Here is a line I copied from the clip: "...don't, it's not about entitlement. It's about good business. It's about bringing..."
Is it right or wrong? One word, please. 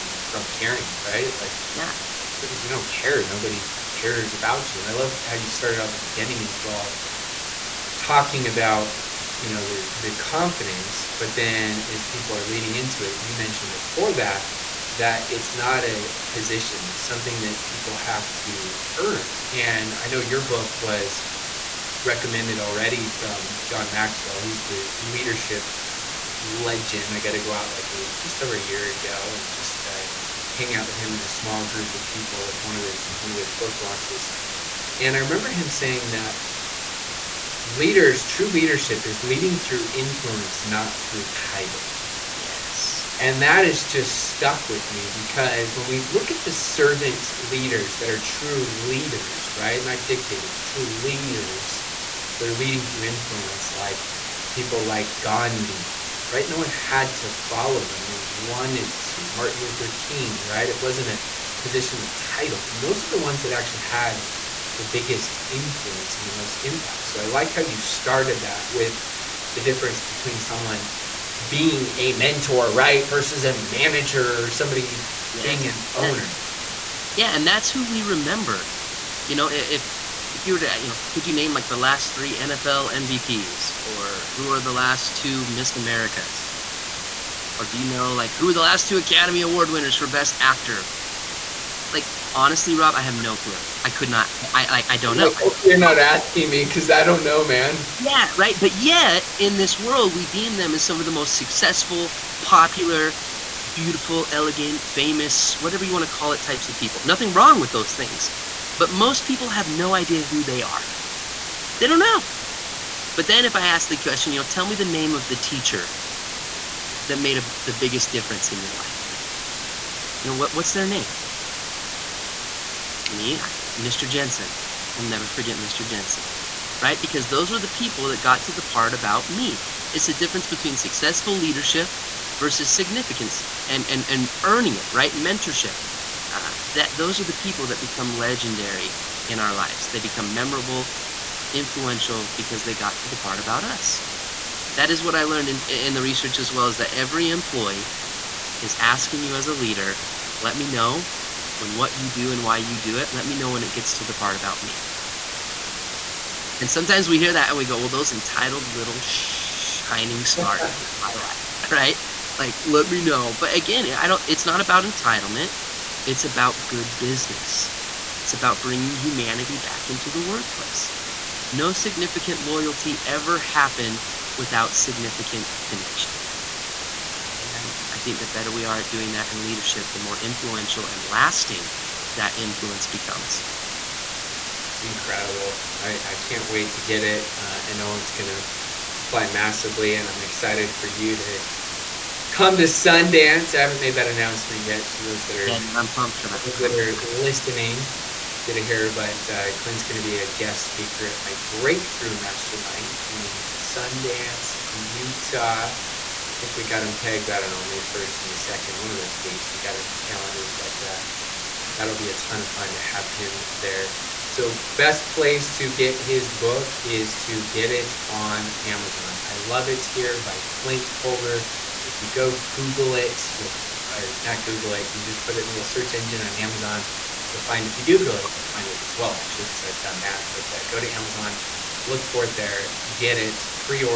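right.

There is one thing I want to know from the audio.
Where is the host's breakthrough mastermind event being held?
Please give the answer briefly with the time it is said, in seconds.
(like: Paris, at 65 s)
Sundance, Utah, at 203 s.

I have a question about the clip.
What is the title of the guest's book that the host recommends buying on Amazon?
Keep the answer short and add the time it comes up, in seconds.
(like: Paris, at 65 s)
I Love It Here, at 219 s.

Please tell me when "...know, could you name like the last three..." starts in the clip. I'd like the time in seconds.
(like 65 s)
80 s.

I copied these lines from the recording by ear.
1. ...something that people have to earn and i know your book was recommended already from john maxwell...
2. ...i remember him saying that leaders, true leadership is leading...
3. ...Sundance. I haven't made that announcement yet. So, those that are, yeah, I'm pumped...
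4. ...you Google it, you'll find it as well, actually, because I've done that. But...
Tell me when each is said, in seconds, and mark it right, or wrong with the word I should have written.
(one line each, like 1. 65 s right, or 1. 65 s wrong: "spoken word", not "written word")
1. 17 s right
2. 35 s right
3. 192 s right
4. 227 s right.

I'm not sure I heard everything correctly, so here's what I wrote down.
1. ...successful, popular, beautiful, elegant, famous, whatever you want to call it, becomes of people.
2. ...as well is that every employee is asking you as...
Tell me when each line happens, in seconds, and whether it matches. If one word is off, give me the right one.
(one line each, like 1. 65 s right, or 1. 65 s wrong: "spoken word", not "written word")
1. 101 s wrong: "types", not "becomes"
2. 146 s right.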